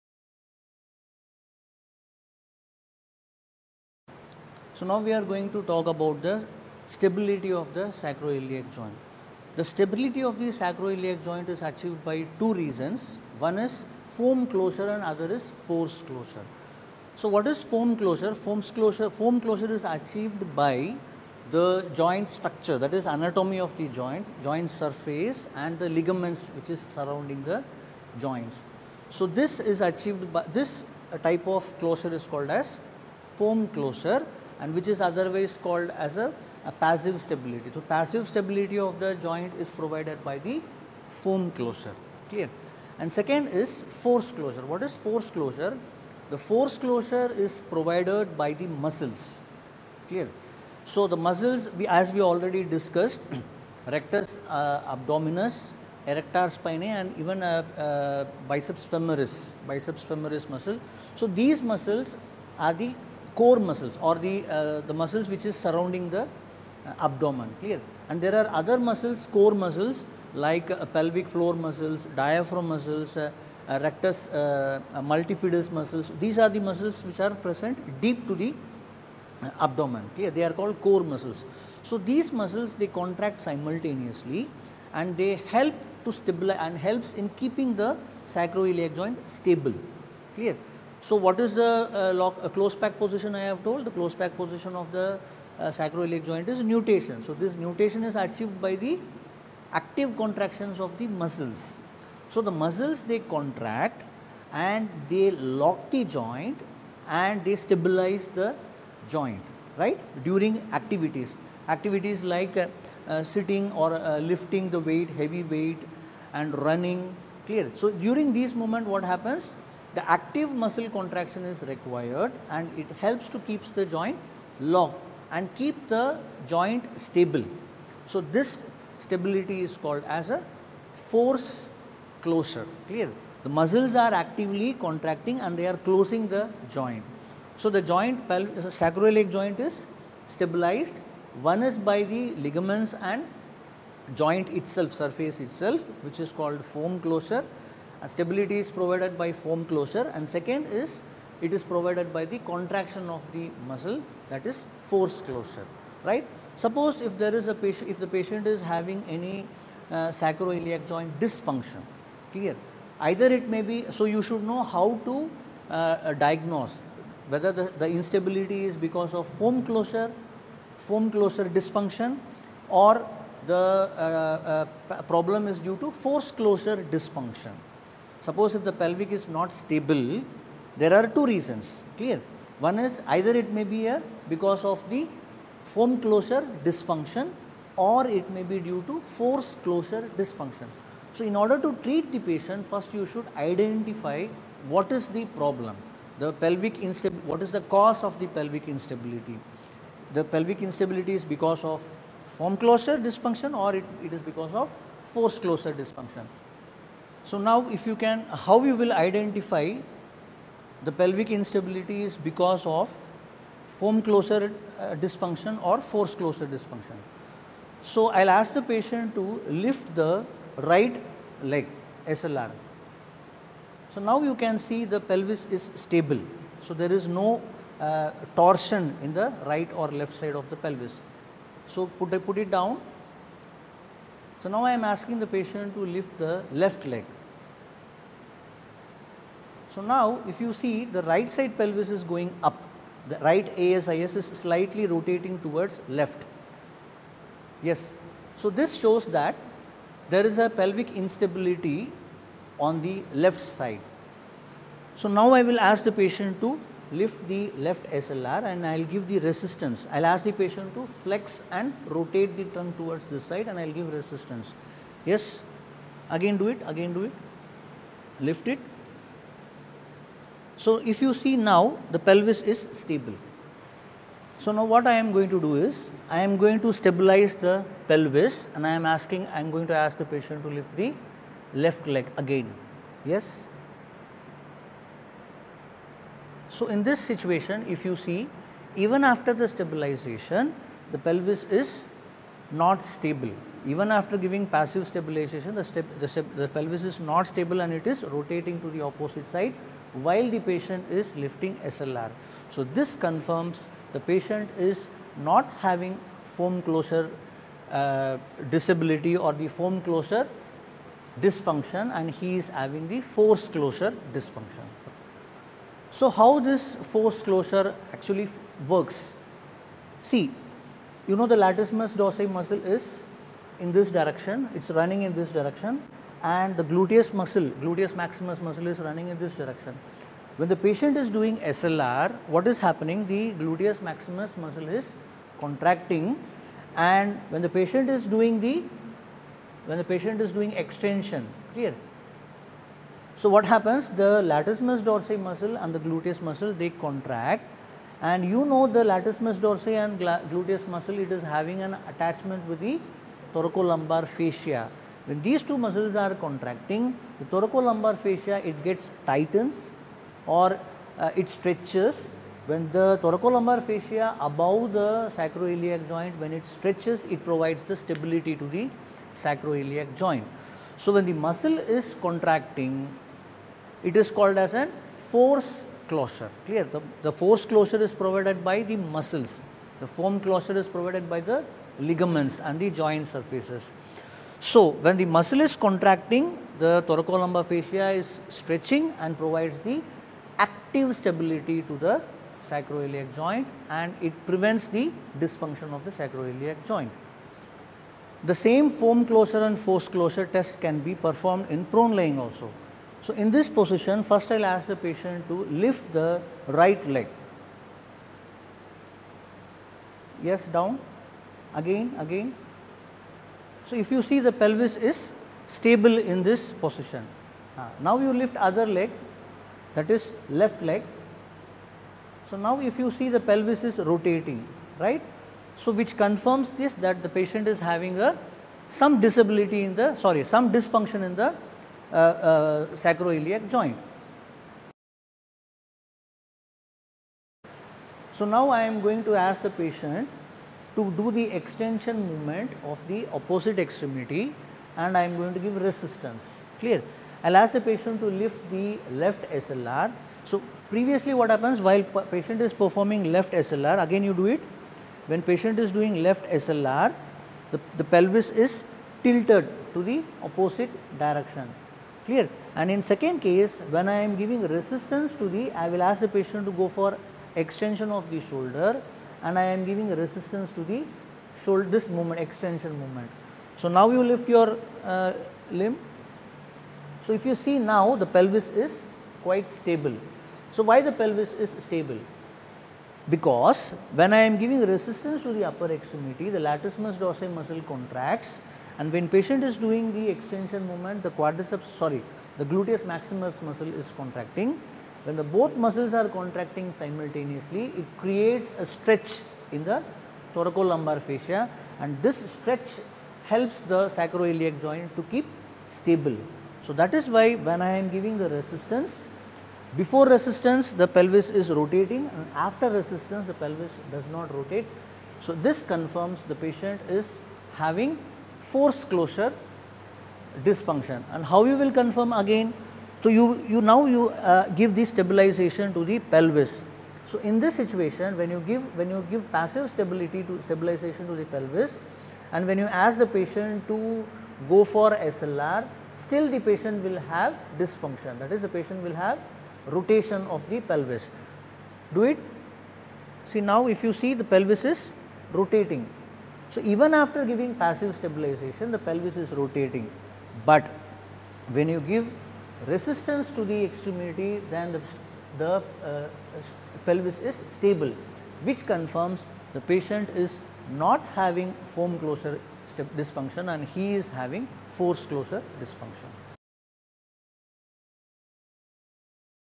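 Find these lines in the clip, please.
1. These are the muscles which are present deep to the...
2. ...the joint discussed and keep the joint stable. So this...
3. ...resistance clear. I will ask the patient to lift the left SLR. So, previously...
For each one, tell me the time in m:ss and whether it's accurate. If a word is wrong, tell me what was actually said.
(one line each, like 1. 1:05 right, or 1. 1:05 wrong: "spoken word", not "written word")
1. 1:16 right
2. 2:03 wrong: "locked", not "discussed"
3. 7:25 right.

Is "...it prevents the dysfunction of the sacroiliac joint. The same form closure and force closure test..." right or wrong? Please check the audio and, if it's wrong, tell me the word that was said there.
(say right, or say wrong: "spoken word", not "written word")
right.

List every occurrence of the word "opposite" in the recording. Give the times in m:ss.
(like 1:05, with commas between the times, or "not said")
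4:58, 7:23, 7:40.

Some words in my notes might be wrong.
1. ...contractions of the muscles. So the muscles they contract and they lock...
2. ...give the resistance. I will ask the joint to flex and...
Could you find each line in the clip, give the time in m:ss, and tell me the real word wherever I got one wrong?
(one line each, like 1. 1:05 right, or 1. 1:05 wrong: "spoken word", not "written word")
1. 1:40 right
2. 4:18 wrong: "patient", not "joint".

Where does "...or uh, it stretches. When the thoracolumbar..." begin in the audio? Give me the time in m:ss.
6:00.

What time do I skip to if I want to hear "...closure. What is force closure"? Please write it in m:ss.
0:44.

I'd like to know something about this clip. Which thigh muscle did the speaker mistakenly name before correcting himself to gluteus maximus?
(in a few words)
quadriceps.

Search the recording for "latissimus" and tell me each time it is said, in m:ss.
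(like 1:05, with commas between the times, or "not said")
5:21, 5:44, 5:48, 8:06.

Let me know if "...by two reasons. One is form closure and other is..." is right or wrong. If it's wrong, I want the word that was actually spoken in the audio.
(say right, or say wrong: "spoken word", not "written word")
right.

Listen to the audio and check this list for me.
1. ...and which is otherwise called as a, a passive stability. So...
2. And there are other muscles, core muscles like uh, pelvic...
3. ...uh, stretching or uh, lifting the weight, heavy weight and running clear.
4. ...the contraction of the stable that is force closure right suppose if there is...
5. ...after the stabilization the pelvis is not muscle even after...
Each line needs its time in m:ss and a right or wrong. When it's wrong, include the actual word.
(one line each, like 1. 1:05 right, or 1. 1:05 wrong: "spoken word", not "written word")
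1. 0:34 right
2. 1:08 right
3. 1:53 wrong: "sitting", not "stretching"
4. 2:32 wrong: "muscle", not "stable"
5. 4:49 wrong: "stable", not "muscle".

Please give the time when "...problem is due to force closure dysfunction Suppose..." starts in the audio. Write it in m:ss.
2:55.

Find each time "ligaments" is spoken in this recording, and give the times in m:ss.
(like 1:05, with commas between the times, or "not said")
0:25, 2:22, 6:21.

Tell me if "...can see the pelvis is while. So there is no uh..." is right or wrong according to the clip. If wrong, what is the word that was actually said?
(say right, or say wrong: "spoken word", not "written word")
wrong: "stable", not "while".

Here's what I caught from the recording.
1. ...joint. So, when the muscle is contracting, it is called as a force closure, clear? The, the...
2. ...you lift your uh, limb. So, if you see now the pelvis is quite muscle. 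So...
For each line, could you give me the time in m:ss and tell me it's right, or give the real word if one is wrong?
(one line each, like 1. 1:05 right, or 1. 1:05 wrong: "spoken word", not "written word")
1. 6:09 right
2. 7:53 wrong: "stable", not "muscle".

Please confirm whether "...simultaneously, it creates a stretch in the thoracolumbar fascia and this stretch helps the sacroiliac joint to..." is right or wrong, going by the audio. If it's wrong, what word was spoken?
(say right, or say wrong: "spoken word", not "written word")
right.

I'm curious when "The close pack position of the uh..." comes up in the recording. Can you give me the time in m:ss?
1:33.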